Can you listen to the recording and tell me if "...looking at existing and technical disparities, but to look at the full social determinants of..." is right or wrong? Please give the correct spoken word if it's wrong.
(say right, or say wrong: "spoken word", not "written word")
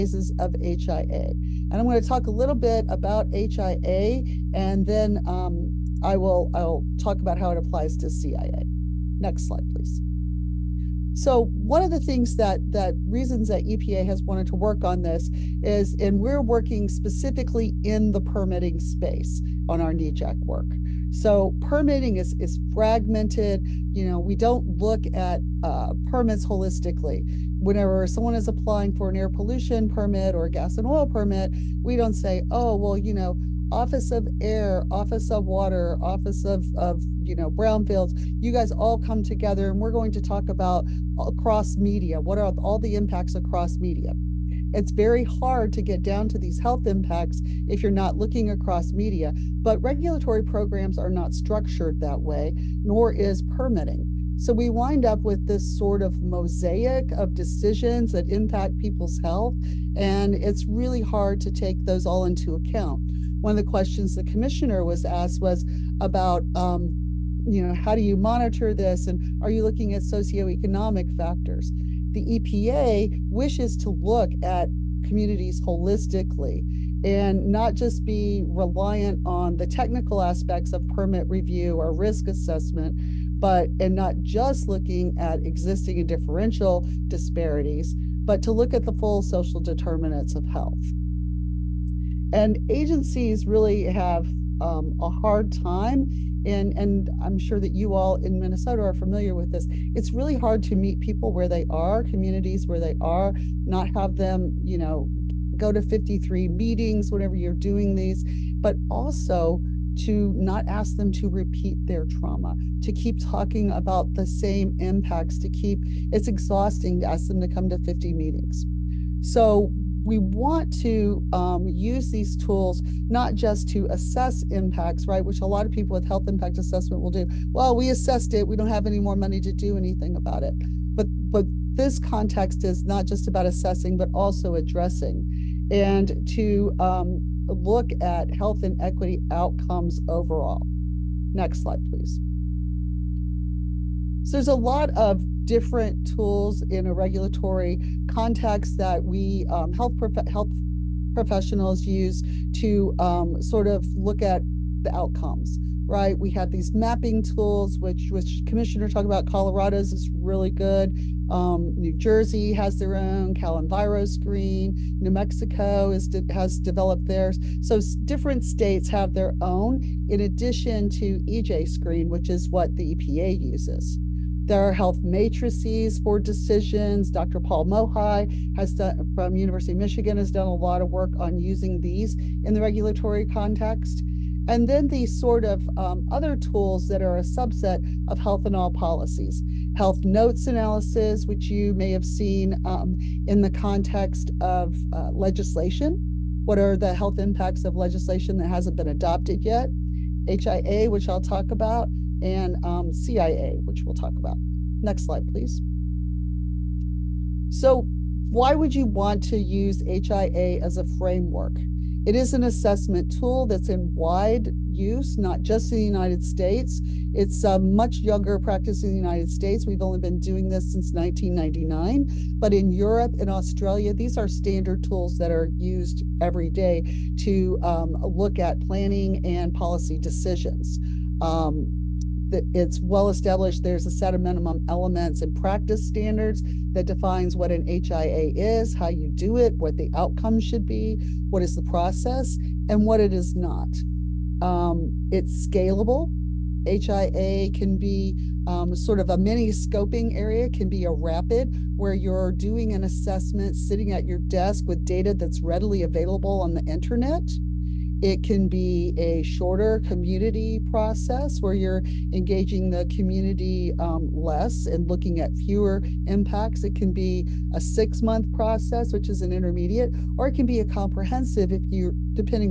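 wrong: "differential", not "technical".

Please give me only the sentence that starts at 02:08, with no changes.
We don't have any more money to do anything about it.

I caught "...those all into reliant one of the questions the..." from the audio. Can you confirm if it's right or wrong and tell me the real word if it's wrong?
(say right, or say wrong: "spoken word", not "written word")
wrong: "account", not "reliant".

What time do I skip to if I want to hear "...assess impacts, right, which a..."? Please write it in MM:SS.
02:03.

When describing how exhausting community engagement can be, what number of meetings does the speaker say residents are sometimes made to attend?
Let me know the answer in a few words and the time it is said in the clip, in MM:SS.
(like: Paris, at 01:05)
53, at 01:45.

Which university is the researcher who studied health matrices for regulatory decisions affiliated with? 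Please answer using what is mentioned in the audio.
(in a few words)
University of Michigan.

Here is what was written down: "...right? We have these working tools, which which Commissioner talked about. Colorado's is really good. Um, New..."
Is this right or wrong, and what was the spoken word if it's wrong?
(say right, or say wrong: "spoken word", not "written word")
wrong: "mapping", not "working".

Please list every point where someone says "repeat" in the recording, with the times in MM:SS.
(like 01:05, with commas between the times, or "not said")
01:51.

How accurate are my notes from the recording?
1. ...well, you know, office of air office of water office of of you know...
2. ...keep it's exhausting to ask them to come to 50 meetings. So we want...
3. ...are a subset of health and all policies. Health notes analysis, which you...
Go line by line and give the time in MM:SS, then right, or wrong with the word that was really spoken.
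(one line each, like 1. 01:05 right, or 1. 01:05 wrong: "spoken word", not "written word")
1. 00:32 right
2. 01:55 right
3. 03:07 right.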